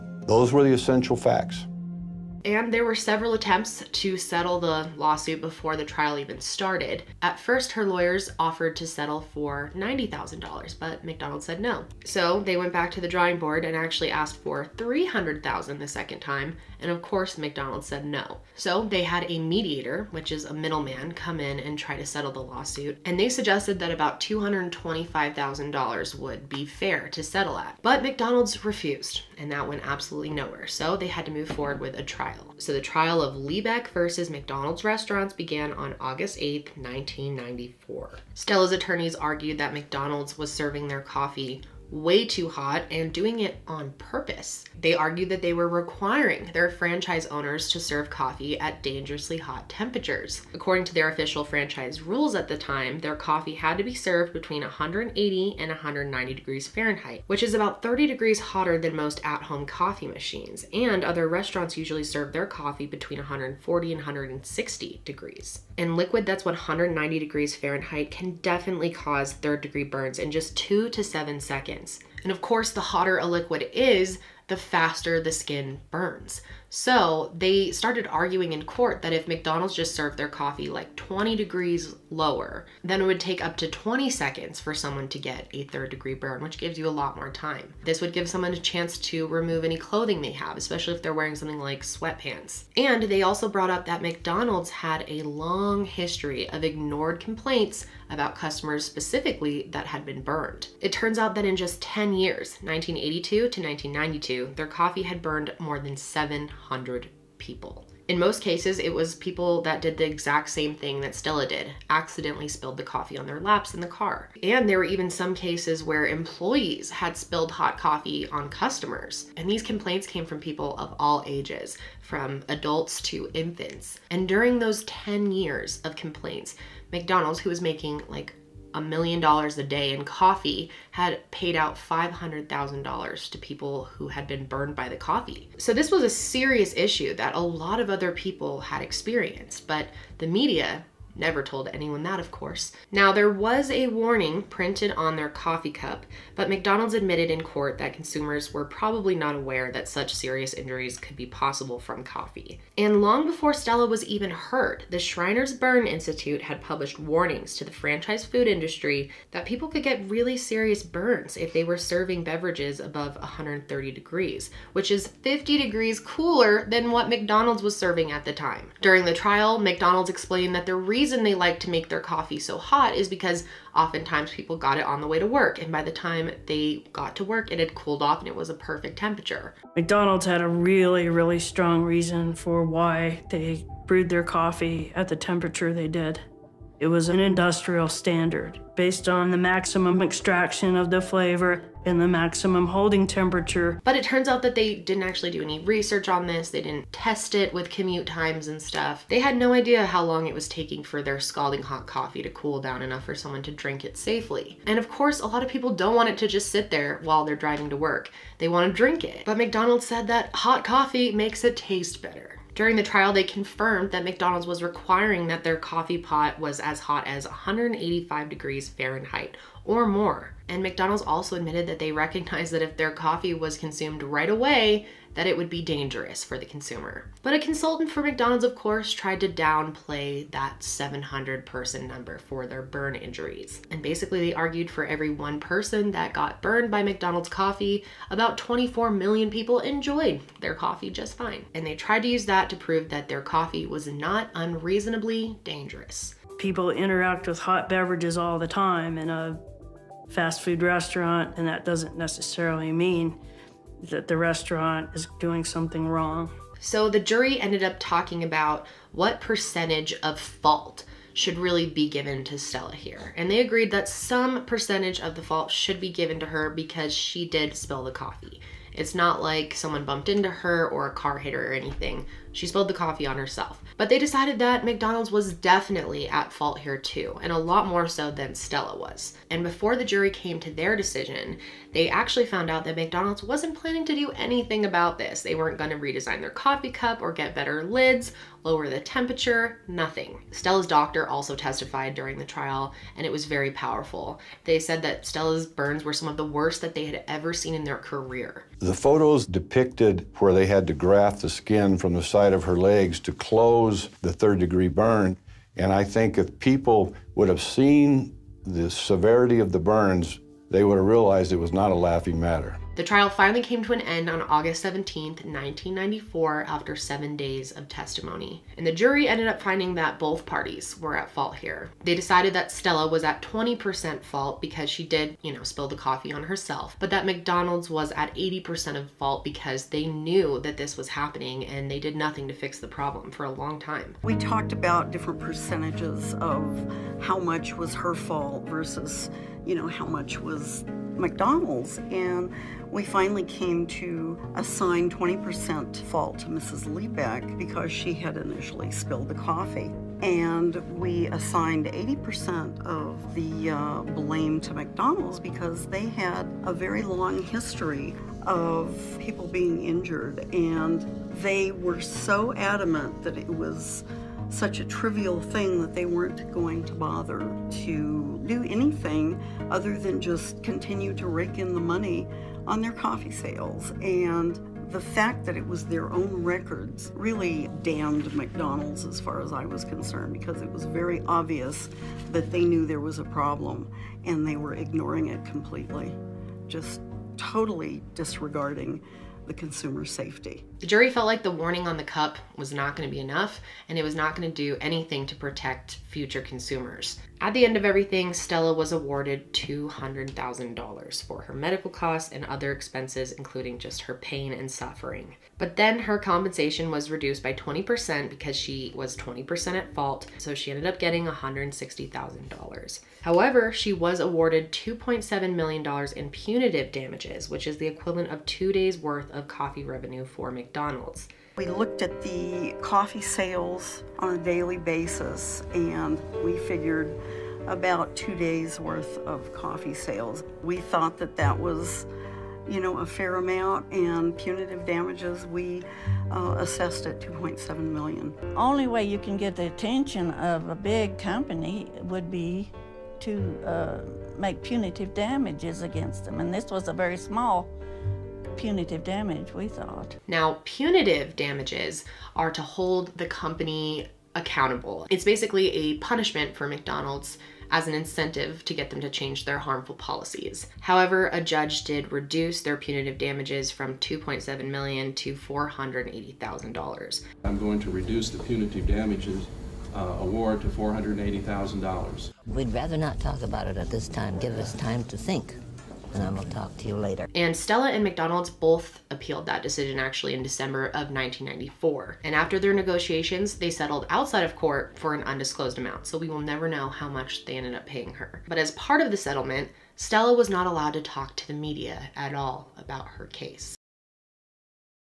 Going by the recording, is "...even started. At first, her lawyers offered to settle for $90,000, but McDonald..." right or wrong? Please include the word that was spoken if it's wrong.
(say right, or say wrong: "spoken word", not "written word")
right.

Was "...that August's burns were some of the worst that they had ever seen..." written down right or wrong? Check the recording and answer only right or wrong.
wrong.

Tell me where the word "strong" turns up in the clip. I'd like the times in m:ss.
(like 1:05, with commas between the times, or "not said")
3:01.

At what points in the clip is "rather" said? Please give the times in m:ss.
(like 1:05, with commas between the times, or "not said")
7:52.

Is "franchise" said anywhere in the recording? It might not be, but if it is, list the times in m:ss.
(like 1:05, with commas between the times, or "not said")
0:46, 0:51, 2:37.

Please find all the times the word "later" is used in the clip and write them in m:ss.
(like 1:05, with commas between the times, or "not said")
7:56.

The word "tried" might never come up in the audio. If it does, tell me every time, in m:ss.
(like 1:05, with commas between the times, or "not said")
3:48, 4:01.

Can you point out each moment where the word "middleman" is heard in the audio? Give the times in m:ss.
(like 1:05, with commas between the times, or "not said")
0:20.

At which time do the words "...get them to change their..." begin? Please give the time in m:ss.
7:38.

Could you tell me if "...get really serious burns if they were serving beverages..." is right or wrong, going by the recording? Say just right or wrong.
right.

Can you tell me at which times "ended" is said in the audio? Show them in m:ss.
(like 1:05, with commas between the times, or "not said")
4:17, 5:19, 6:50, 8:07.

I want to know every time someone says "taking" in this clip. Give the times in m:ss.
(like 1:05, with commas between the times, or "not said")
3:20.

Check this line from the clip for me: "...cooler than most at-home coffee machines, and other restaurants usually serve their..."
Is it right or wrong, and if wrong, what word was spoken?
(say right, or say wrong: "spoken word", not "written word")
wrong: "hotter", not "cooler".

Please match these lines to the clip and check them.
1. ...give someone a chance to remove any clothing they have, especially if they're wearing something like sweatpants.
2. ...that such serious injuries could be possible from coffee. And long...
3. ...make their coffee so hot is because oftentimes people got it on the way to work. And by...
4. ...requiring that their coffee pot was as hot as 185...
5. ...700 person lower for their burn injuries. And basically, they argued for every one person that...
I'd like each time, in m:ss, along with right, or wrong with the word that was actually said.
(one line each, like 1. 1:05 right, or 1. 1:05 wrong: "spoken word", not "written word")
1. 1:28 right
2. 2:29 right
3. 2:51 right
4. 3:34 right
5. 3:50 wrong: "number", not "lower".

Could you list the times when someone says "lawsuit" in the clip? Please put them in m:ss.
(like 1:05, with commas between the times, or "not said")
0:04, 0:22.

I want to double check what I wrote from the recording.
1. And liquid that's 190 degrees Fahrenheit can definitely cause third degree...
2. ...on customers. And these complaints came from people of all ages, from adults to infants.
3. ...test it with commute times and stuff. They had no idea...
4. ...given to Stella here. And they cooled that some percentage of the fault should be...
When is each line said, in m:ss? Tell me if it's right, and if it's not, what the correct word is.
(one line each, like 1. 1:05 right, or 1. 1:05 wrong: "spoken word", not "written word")
1. 1:05 right
2. 1:58 right
3. 3:16 right
4. 4:21 wrong: "agreed", not "cooled".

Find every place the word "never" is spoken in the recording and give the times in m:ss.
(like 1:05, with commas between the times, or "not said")
2:21, 8:06.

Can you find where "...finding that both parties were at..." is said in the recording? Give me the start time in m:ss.
5:19.